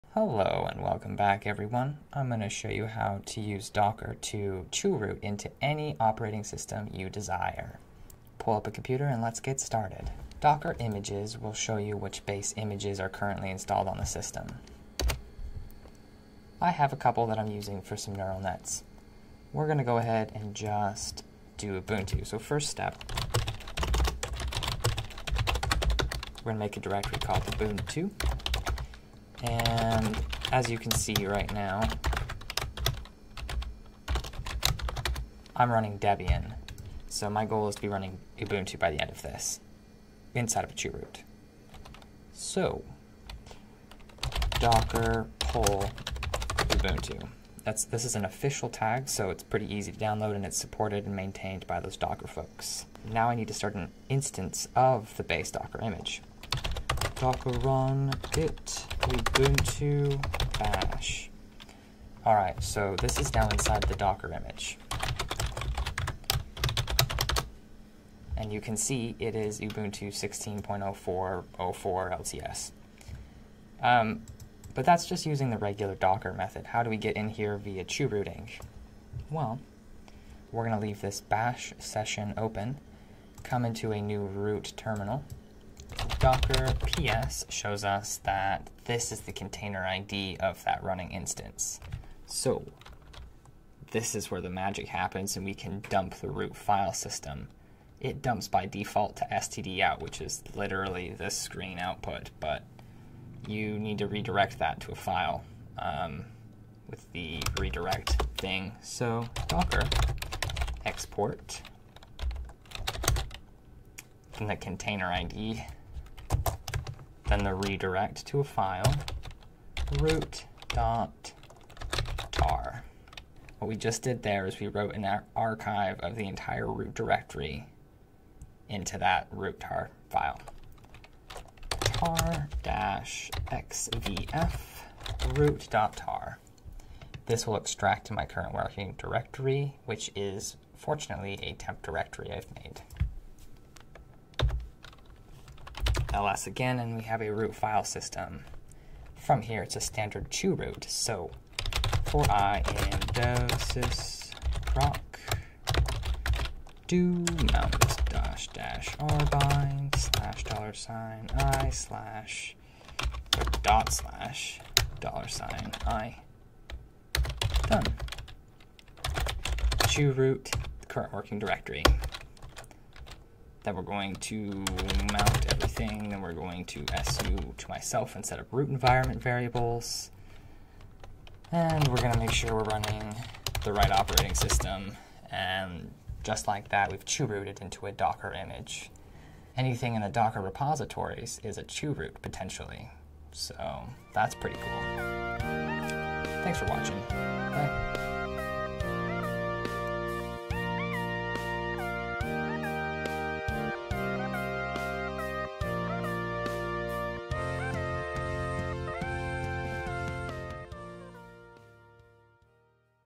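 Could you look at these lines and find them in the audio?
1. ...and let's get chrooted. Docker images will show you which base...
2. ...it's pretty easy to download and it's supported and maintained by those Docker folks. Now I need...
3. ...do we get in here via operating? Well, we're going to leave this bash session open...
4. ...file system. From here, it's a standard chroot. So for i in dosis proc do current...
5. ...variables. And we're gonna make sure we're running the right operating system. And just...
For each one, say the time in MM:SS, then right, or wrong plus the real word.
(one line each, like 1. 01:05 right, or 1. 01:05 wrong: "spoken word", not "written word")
1. 00:09 wrong: "started", not "chrooted"
2. 00:49 right
3. 01:16 wrong: "rooting", not "operating"
4. 02:27 wrong: "mount", not "current"
5. 02:59 right.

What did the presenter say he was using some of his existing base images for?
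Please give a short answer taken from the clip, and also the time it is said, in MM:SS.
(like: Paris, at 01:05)
neural nets, at 00:18.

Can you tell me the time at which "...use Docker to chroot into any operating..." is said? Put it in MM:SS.
00:03.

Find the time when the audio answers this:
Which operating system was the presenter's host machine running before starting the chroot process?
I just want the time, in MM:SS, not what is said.
00:35.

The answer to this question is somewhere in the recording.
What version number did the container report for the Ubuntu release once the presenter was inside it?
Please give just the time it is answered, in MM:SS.
01:10.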